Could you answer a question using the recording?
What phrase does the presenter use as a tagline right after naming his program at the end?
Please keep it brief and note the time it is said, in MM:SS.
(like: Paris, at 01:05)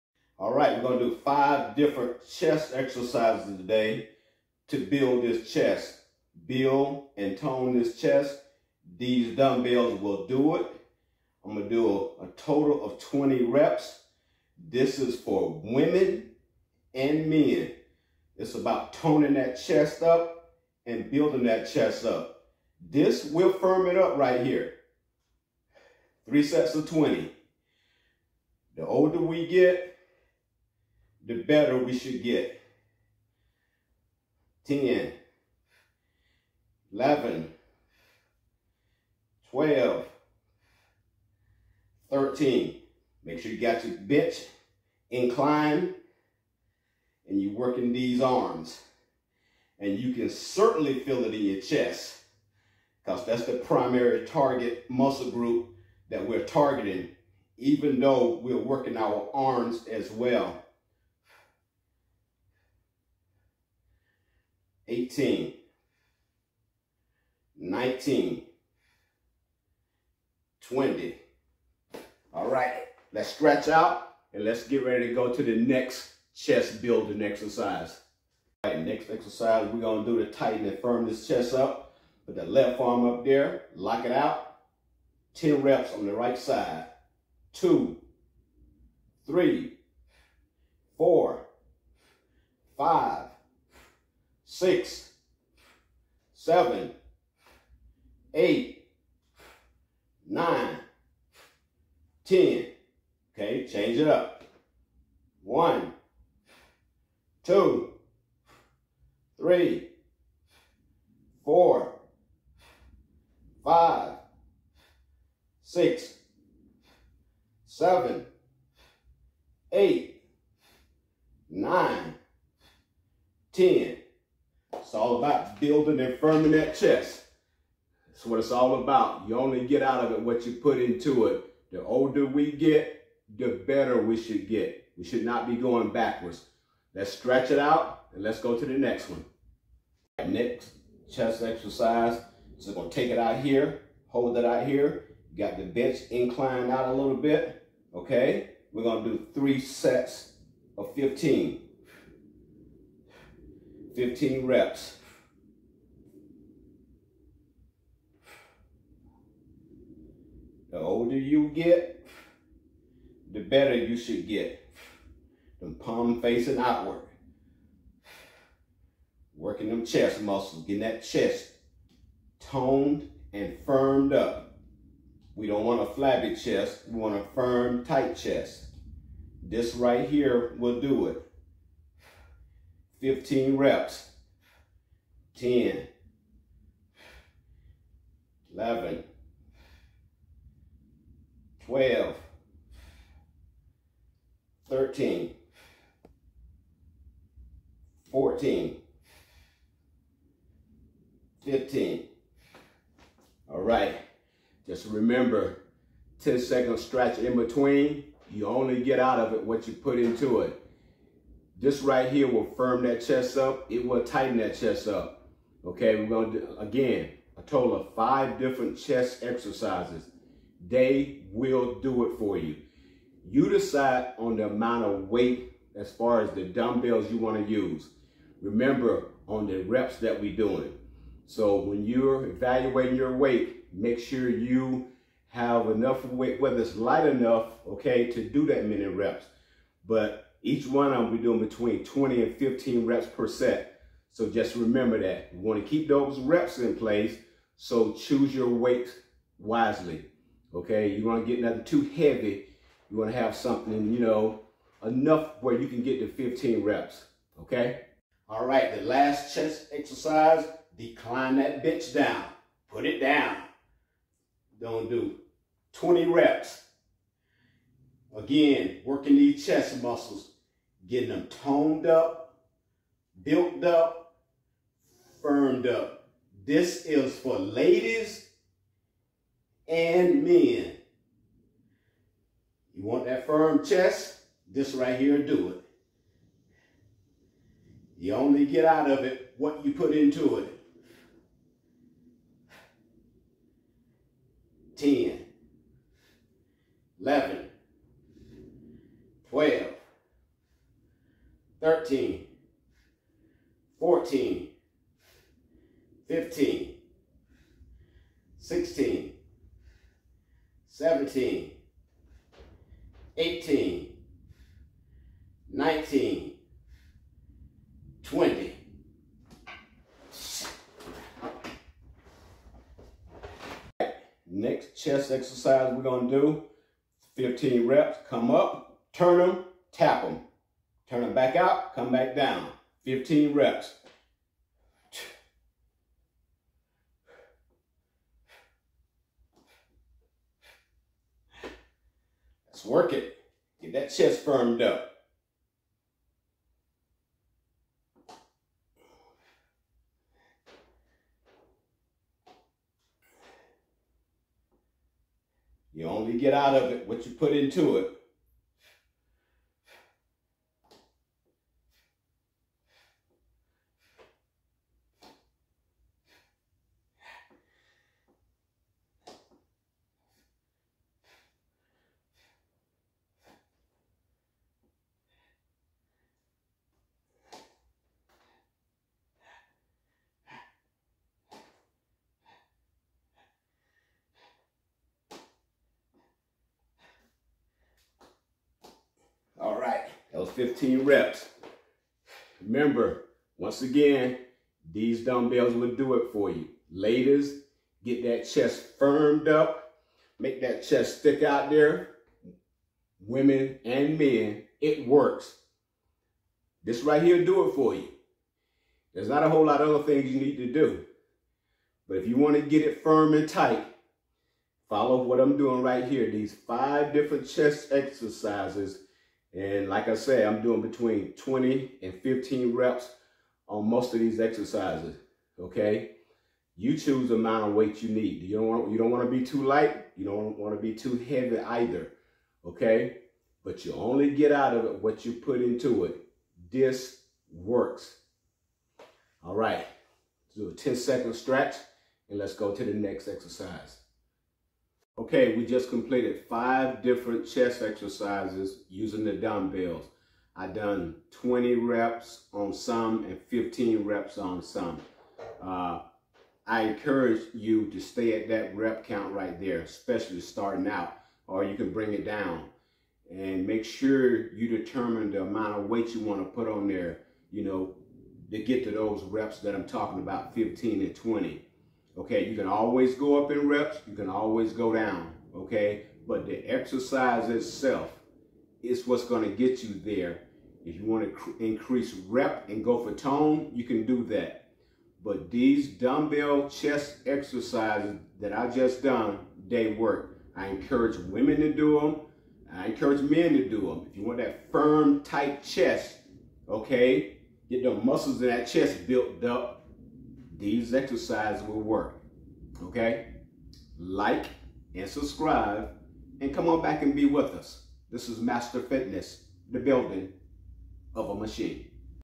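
The building of a machine, at 08:29.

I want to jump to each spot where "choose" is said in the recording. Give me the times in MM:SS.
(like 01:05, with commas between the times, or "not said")
04:07, 07:06.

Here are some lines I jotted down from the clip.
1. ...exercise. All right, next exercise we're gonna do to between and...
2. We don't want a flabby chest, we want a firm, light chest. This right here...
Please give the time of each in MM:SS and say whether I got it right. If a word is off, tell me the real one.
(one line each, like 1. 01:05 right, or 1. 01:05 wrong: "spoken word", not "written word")
1. 01:17 wrong: "tighten", not "between"
2. 02:55 wrong: "tight", not "light".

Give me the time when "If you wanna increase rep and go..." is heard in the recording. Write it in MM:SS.
08:00.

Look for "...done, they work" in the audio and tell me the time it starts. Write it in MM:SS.
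08:08.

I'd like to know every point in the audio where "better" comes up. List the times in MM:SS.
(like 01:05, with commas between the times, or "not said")
00:31, 02:13, 02:43.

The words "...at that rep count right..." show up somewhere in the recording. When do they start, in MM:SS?
07:38.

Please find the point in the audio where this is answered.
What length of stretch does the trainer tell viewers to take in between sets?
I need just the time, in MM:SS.
03:26.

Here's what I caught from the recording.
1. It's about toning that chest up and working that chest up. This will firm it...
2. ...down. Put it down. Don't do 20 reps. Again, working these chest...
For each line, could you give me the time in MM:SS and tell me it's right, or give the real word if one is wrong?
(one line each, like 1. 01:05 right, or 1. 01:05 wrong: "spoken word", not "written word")
1. 00:18 wrong: "building", not "working"
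2. 04:21 right.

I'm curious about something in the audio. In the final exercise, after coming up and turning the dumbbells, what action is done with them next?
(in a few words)
Tap them.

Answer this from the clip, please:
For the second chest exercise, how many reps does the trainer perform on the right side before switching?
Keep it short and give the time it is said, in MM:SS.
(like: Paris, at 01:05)
10, at 01:25.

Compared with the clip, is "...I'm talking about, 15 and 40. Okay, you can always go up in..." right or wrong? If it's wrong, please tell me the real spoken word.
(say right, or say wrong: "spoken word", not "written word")
wrong: "20", not "40".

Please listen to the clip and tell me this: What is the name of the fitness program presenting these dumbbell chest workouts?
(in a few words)
Master Fitness.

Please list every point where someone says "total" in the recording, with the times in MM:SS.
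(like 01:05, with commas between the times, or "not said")
00:12, 03:37.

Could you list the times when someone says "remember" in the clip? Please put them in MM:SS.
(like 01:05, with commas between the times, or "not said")
03:24, 03:48, 04:04, 06:32.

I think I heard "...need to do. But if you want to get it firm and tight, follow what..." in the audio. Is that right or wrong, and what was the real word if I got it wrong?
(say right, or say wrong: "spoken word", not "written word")
right.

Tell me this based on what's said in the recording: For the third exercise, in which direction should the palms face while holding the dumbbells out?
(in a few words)
Outward.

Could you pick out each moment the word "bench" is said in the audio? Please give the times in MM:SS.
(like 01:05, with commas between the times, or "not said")
00:43, 02:25.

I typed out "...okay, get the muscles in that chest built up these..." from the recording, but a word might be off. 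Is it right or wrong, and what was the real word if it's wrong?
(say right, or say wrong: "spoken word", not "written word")
right.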